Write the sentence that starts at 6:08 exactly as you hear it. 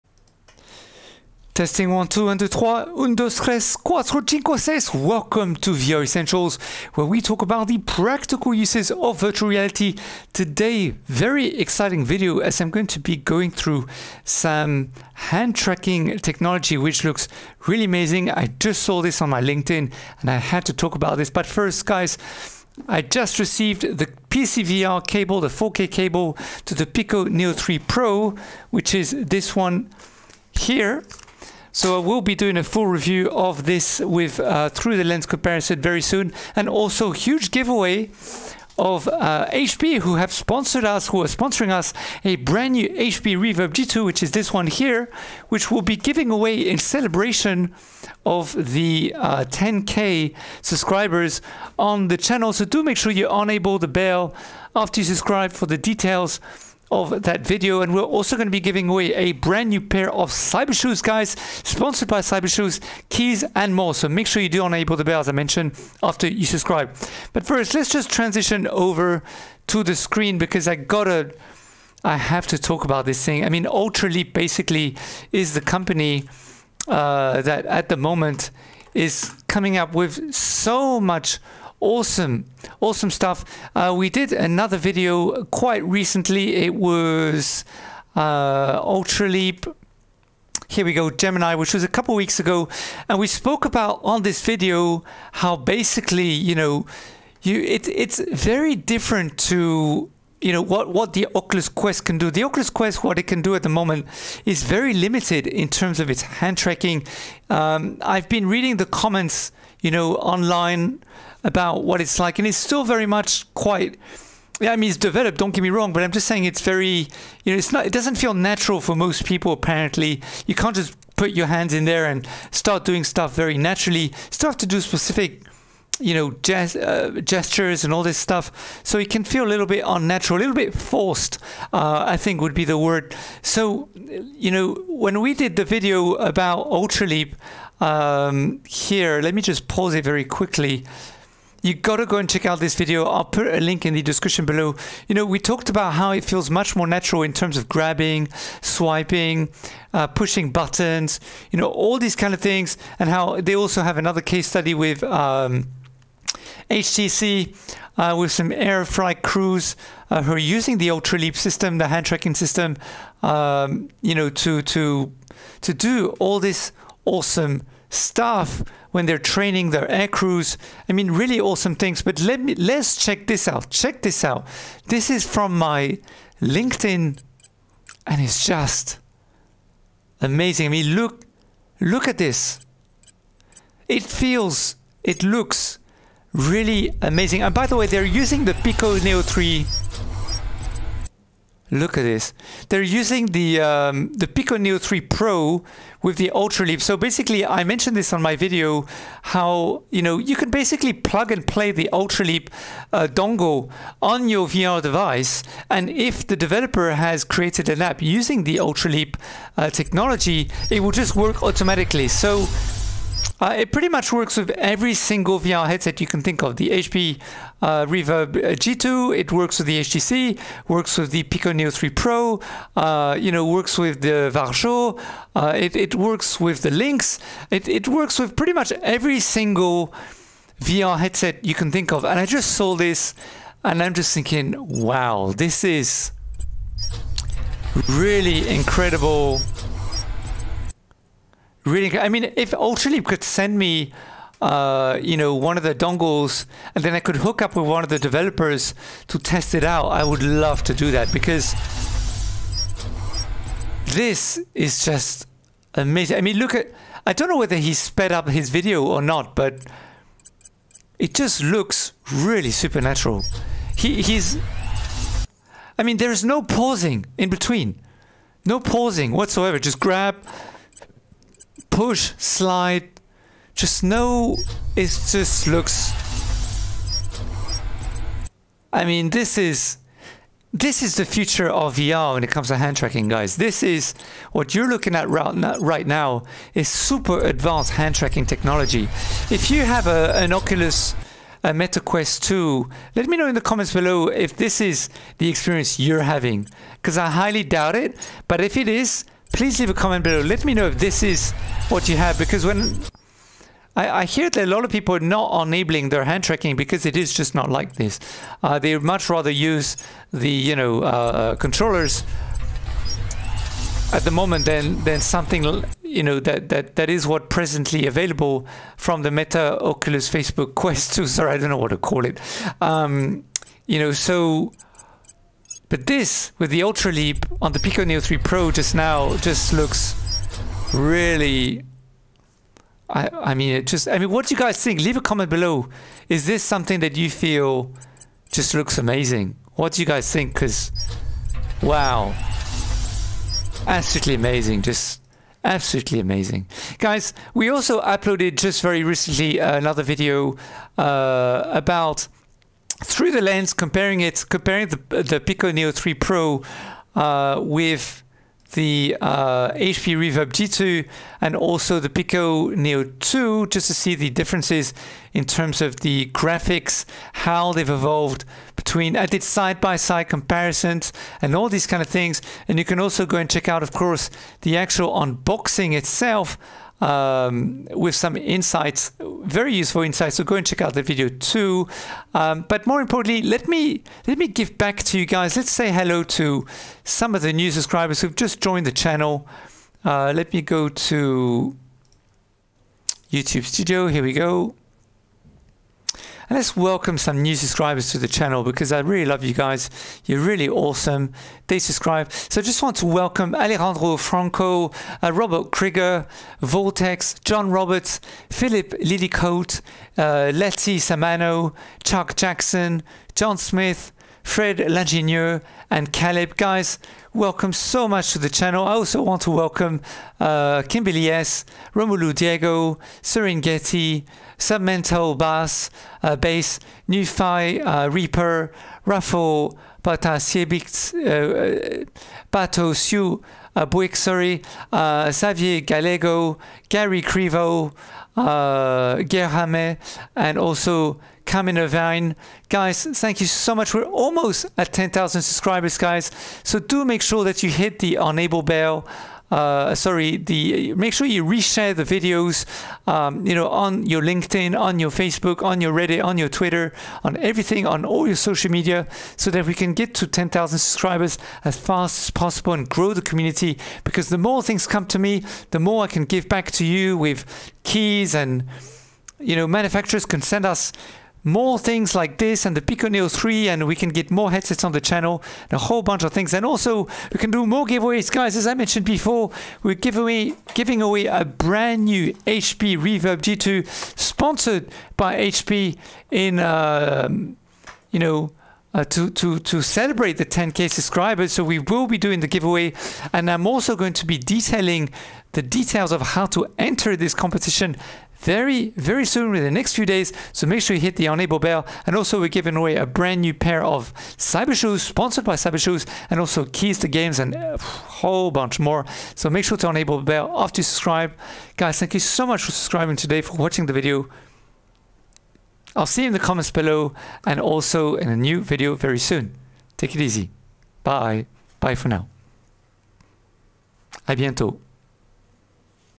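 I did side by side comparisons and all these kind of things.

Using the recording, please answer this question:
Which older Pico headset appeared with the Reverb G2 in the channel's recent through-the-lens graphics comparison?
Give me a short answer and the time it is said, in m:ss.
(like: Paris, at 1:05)
Pico Neo 2, at 6:01.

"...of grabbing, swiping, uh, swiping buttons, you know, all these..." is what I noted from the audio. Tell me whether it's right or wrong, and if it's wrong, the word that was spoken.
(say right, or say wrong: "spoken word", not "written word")
wrong: "pushing", not "swiping".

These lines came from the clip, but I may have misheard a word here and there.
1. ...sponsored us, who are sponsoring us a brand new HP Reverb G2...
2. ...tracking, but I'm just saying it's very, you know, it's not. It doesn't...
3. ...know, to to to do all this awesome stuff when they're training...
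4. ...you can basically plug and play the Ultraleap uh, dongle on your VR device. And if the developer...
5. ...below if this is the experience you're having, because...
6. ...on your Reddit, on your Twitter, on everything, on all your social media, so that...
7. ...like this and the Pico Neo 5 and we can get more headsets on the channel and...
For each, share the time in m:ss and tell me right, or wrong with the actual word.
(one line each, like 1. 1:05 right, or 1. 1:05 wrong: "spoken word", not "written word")
1. 0:40 right
2. 1:55 wrong: "wrong", not "tracking"
3. 2:44 right
4. 3:20 right
5. 4:53 right
6. 7:35 right
7. 7:51 wrong: "3", not "5".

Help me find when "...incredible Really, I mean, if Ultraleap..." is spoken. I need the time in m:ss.
3:58.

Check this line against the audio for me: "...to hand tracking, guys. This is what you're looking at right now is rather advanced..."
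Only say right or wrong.
wrong.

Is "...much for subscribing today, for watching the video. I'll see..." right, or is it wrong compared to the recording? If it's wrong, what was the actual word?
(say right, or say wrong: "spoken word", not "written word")
right.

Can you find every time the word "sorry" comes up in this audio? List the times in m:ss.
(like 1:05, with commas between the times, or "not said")
5:21, 7:13, 7:29.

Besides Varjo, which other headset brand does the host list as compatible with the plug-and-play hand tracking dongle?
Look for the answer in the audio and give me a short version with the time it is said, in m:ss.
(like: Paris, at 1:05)
Lynx, at 3:46.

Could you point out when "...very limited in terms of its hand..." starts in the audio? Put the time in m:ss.
1:44.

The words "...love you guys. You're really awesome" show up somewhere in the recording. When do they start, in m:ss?
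6:39.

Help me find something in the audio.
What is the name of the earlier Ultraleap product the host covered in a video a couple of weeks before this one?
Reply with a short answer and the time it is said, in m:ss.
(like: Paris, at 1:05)
Gemini, at 1:31.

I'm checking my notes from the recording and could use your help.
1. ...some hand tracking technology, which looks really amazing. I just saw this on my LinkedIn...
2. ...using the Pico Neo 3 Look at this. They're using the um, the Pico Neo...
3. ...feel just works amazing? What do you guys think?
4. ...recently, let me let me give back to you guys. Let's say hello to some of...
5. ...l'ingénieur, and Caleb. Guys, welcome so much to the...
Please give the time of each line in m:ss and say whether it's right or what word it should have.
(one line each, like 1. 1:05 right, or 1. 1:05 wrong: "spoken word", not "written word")
1. 0:14 right
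2. 3:08 right
3. 5:37 wrong: "looks", not "works"
4. 6:22 wrong: "importantly", not "recently"
5. 6:54 right.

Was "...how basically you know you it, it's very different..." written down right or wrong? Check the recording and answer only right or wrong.
right.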